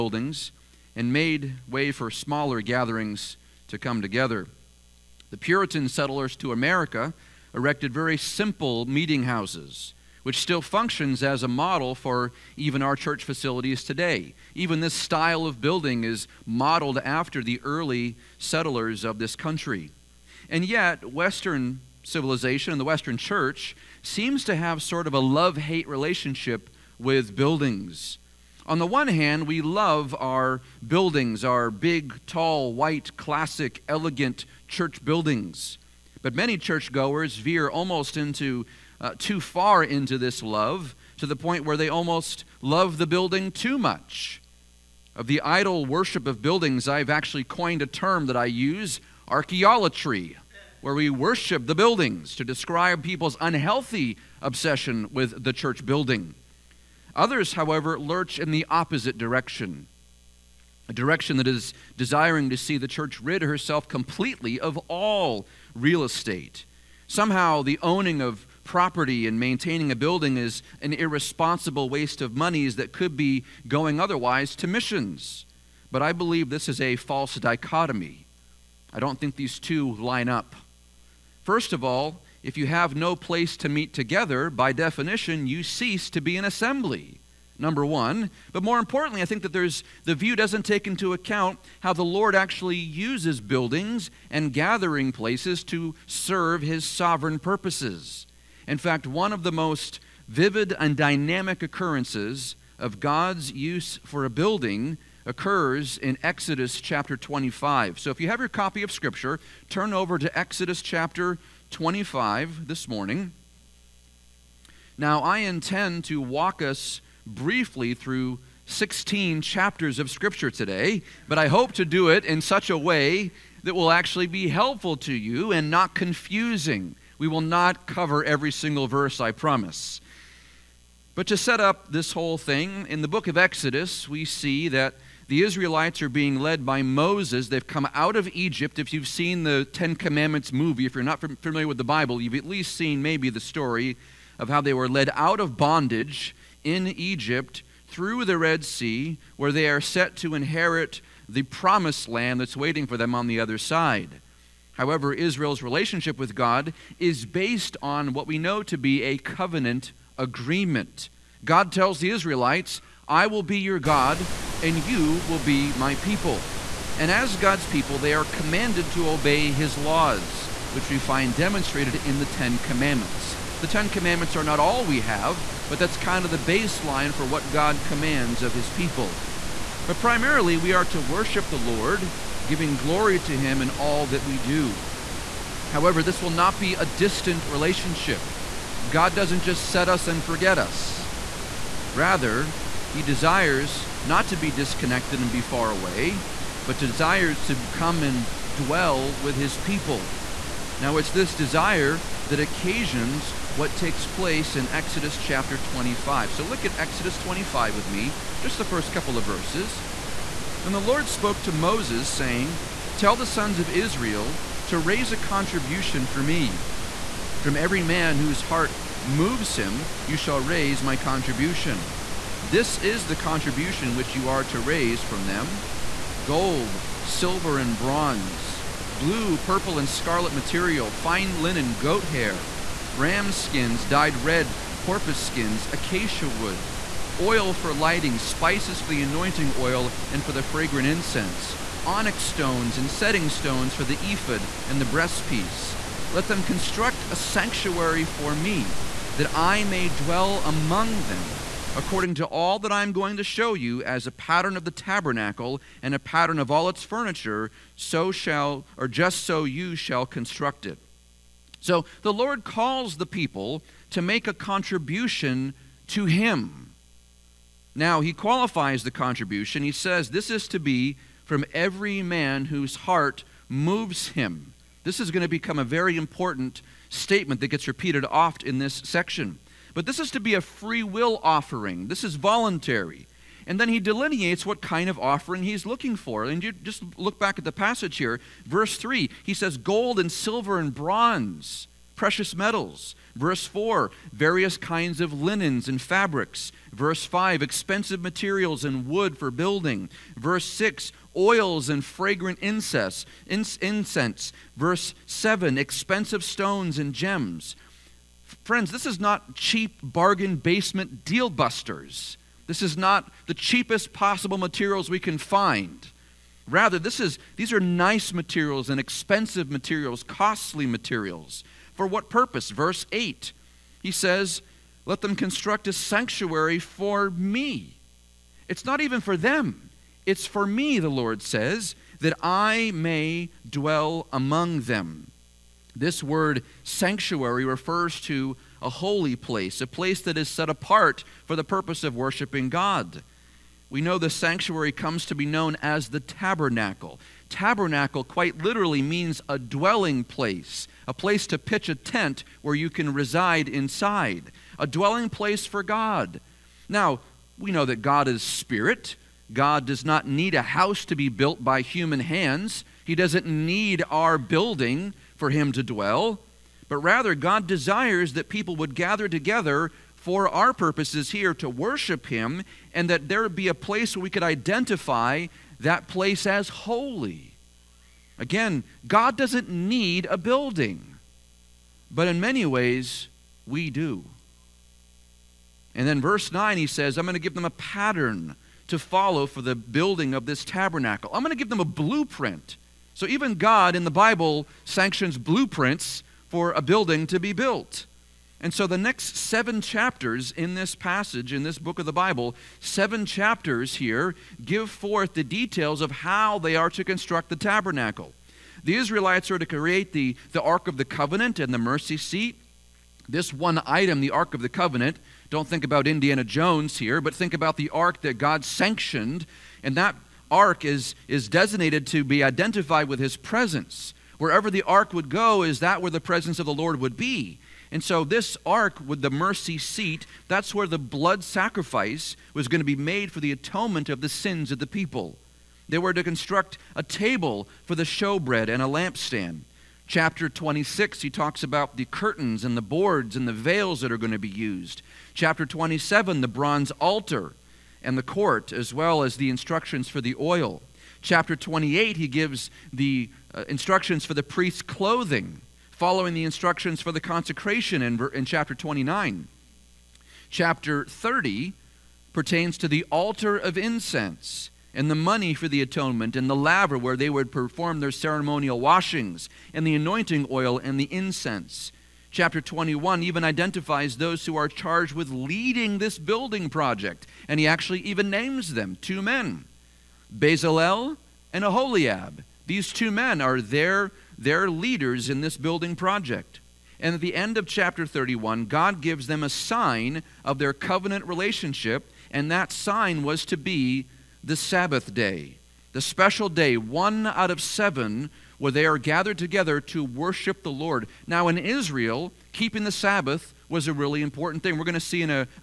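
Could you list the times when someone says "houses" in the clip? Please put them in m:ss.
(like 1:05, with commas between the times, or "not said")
0:09, 6:00.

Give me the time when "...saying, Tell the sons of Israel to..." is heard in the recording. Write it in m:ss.
3:32.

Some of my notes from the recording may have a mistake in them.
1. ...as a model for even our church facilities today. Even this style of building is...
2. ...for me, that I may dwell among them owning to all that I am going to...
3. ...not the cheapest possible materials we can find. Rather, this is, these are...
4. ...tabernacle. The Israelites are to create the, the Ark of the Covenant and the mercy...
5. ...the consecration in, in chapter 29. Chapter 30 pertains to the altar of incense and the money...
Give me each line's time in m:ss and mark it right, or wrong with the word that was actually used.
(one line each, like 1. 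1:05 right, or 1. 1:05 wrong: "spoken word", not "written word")
1. 0:11 right
2. 4:08 wrong: "according", not "owning"
3. 5:12 right
4. 6:47 right
5. 7:36 right.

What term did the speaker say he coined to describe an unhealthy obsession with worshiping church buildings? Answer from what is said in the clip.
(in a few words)
archaeolatry.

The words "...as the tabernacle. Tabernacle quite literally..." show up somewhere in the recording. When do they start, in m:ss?
5:45.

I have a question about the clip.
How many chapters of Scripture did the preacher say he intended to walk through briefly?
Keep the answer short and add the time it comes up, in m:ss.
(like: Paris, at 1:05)
16, at 1:58.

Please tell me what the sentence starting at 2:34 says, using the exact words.
However, Israel's relationship with God is based on what we know to be a covenant agreement.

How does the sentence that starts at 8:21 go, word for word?
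Now, in Israel, keeping the Sabbath was a really important thing.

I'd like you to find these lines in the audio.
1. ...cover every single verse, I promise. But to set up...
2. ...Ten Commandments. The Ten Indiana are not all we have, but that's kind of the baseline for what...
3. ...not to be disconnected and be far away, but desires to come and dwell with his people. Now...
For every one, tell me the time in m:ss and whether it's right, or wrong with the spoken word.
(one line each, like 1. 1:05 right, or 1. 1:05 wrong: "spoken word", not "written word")
1. 2:07 right
2. 2:52 wrong: "Commandments", not "Indiana"
3. 3:14 right.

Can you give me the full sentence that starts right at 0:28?
On the one hand, we love our buildings, our big, tall, white, classic, elegant church buildings.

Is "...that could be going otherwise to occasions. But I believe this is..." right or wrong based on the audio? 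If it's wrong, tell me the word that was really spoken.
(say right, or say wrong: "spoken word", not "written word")
wrong: "missions", not "occasions".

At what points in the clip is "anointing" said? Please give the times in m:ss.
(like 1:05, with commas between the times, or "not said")
3:59, 7:49.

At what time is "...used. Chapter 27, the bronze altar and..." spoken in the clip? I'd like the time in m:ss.
7:24.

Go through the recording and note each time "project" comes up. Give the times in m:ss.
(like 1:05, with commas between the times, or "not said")
7:56, 8:05.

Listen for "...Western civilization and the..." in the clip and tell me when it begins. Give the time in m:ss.
0:21.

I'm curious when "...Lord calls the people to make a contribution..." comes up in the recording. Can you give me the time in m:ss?
4:22.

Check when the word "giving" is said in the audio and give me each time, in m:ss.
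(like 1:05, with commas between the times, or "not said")
3:02.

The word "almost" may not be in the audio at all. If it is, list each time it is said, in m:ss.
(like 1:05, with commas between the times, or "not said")
0:37, 0:41.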